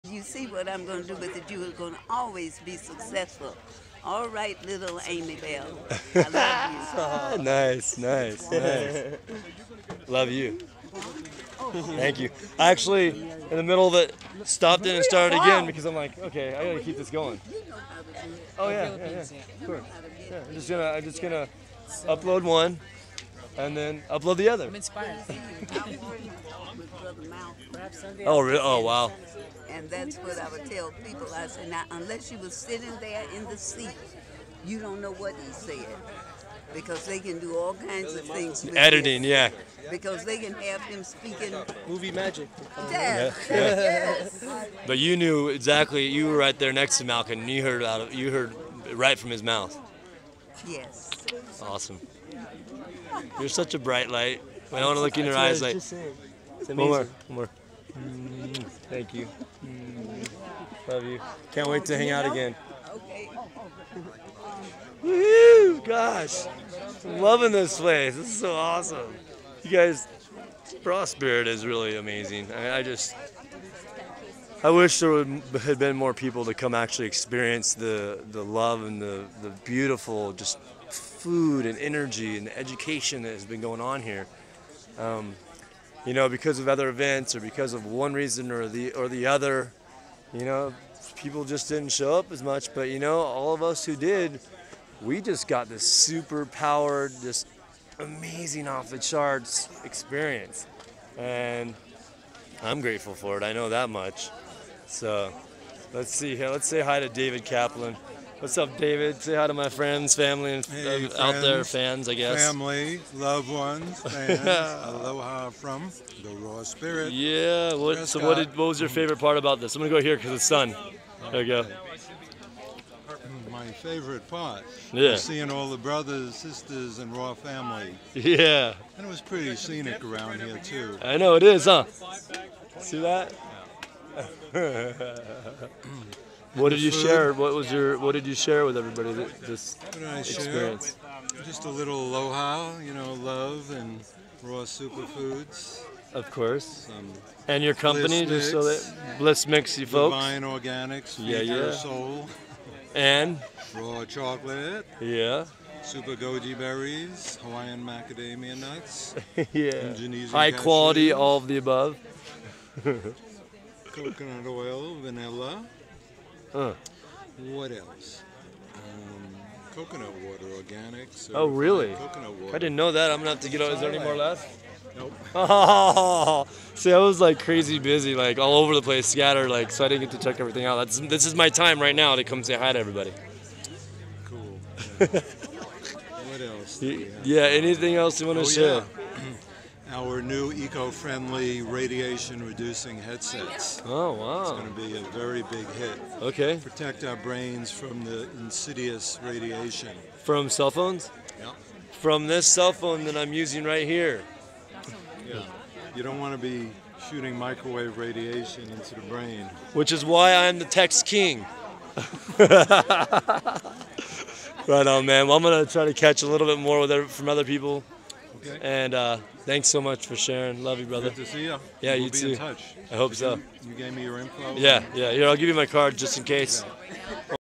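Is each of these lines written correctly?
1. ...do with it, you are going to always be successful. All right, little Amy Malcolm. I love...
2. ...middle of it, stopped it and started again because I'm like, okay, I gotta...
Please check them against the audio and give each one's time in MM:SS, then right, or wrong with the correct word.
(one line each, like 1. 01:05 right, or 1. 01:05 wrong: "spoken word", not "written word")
1. 00:01 wrong: "Bell", not "Malcolm"
2. 00:13 right.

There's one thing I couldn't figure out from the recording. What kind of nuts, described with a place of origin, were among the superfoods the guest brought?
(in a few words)
Hawaiian macadamia nuts.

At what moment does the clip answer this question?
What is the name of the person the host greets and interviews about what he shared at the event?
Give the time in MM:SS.
01:47.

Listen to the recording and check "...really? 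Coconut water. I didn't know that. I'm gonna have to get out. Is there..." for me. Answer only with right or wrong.
right.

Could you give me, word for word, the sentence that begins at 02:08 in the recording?
And it was pretty scenic around here too.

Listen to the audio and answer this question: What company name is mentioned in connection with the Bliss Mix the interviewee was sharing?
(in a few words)
Divine Organics.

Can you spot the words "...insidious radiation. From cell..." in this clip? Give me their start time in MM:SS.
03:18.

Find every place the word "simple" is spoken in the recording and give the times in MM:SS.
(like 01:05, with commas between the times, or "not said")
not said.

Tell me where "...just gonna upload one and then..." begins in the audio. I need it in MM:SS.
00:21.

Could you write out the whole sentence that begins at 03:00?
That's this is my time right now to come say hi to everybody.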